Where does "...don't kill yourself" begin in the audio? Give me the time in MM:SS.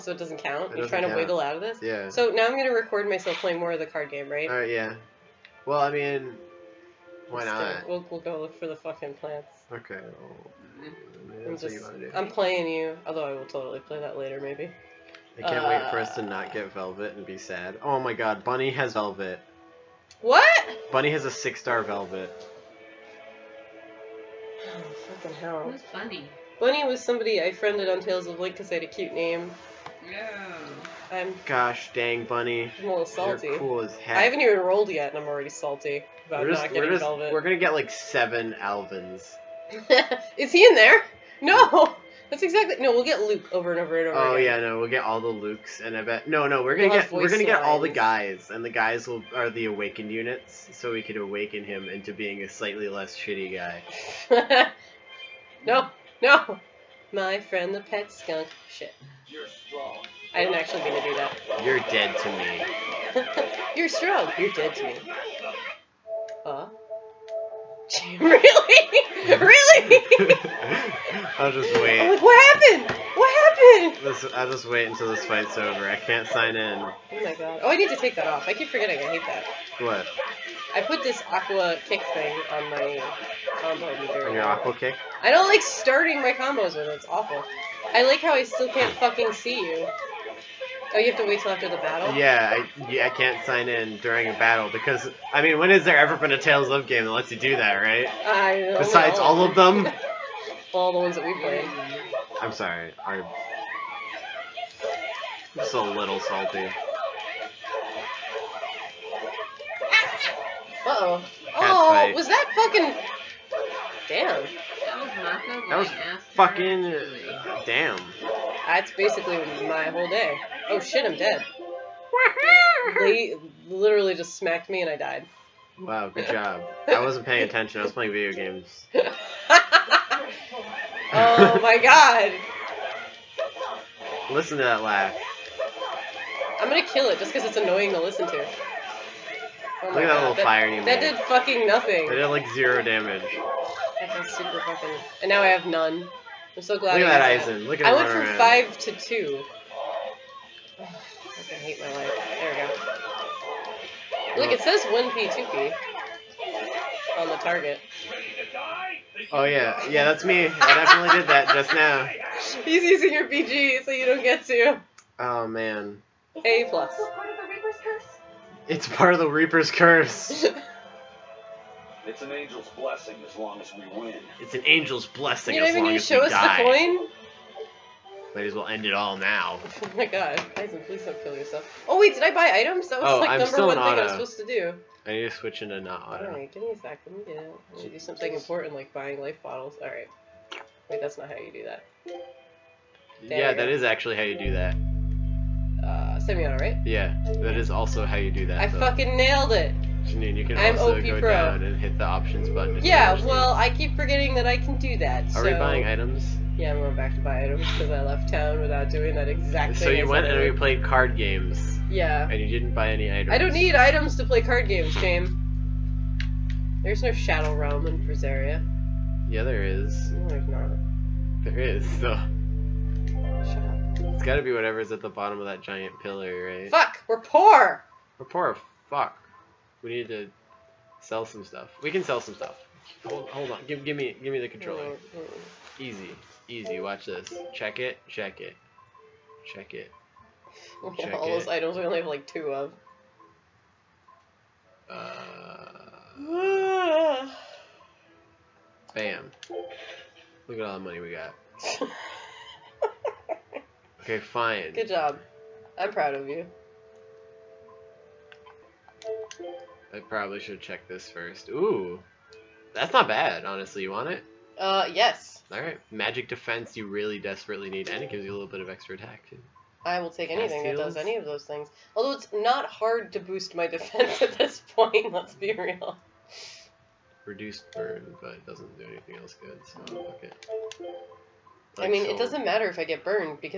03:01.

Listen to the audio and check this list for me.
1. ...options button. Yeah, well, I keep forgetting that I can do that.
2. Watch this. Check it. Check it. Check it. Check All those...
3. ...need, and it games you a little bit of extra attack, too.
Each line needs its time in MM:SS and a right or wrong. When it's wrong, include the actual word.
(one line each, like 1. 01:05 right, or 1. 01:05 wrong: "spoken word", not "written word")
1. 03:22 right
2. 03:56 right
3. 04:27 wrong: "gives", not "games".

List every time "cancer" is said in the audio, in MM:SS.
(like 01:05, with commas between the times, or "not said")
not said.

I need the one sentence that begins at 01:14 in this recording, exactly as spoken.
This, I'll just wait until this fight's over.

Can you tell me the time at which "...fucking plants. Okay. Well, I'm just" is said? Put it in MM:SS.
00:08.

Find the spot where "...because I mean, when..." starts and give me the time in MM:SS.
01:34.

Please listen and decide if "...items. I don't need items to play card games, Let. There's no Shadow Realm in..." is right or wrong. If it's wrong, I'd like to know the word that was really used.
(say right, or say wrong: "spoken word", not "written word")
wrong: "James", not "Let".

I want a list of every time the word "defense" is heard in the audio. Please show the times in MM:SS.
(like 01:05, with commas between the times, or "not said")
04:26, 04:33.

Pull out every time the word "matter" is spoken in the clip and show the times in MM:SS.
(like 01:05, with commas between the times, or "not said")
04:42.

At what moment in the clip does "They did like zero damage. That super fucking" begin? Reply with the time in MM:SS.
02:22.